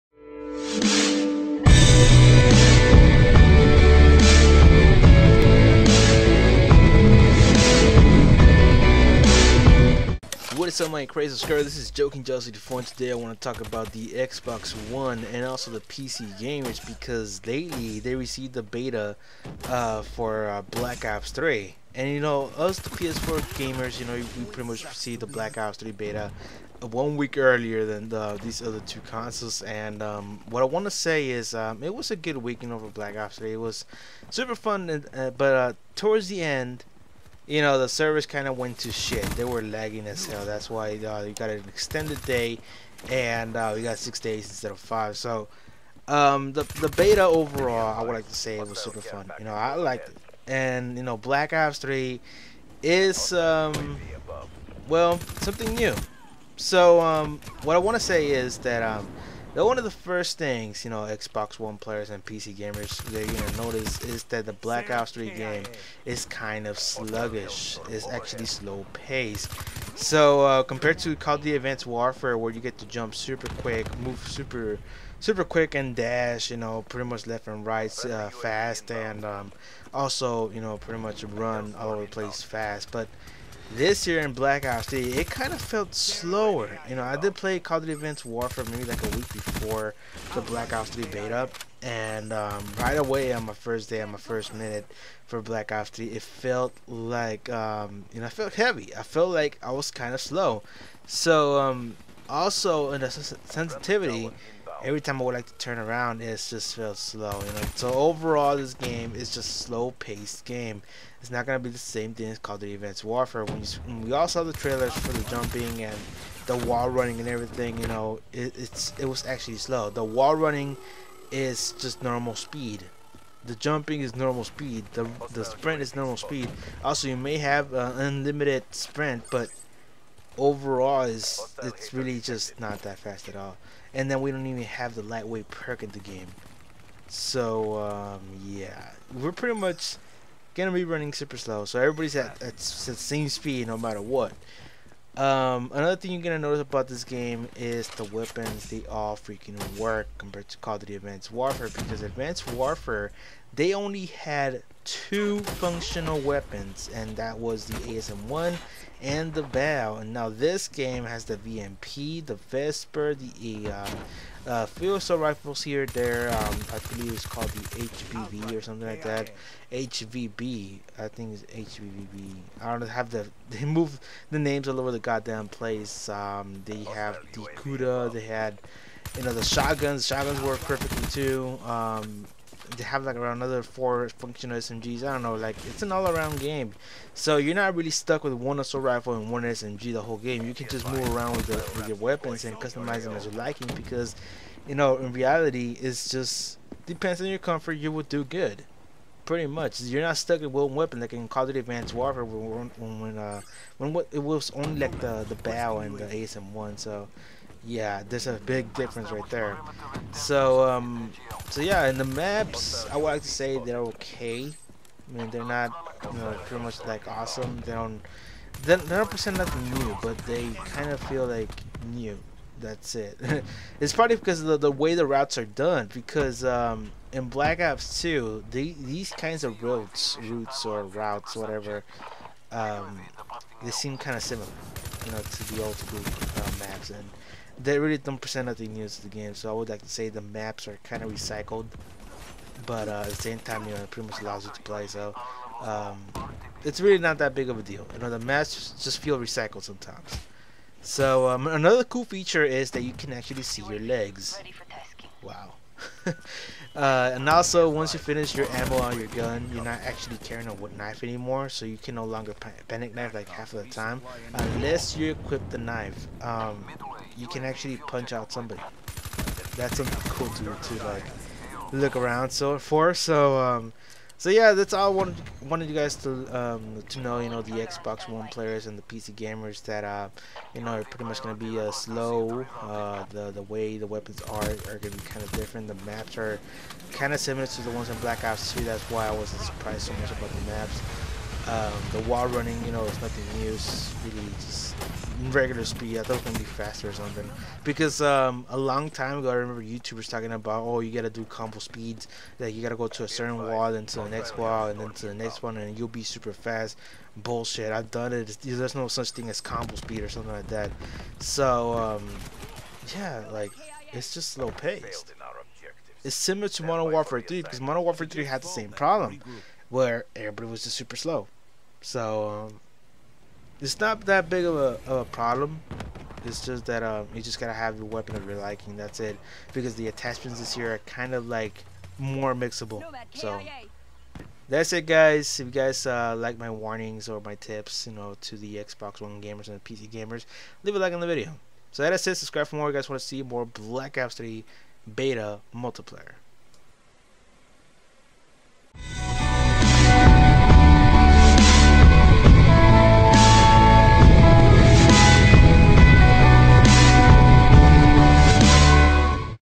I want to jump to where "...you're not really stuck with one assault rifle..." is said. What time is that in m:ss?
3:07.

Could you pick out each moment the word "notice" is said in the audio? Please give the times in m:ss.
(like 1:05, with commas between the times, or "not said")
1:03, 2:26.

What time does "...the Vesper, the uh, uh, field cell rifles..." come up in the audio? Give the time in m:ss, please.
2:42.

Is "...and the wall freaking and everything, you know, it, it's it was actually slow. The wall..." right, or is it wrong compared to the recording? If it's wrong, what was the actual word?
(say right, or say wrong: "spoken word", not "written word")
wrong: "running", not "freaking".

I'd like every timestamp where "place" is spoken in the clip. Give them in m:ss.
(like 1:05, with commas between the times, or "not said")
1:22, 2:55.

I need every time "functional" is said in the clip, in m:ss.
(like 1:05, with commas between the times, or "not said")
2:35, 3:04.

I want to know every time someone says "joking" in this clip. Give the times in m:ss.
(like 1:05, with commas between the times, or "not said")
0:11.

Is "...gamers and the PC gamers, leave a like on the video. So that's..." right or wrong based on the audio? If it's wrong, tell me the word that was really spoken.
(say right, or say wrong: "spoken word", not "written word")
right.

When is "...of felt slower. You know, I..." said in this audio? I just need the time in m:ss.
1:25.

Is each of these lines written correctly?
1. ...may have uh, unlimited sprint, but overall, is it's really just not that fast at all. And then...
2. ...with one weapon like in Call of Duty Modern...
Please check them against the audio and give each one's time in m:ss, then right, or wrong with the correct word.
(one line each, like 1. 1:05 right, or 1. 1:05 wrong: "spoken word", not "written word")
1. 2:07 right
2. 3:20 wrong: "Advanced", not "Modern".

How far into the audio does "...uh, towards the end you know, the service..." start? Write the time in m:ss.
0:35.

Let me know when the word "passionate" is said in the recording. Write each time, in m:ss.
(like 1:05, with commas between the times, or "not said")
not said.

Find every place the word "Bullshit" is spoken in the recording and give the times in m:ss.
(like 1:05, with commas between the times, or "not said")
5:07.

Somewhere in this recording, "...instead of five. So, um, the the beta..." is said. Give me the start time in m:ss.
0:44.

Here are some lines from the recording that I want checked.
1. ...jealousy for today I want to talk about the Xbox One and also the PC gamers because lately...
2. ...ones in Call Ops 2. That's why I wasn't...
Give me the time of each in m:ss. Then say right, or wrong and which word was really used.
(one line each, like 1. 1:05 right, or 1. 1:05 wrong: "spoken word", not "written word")
1. 0:12 right
2. 4:47 wrong: "Black", not "Call".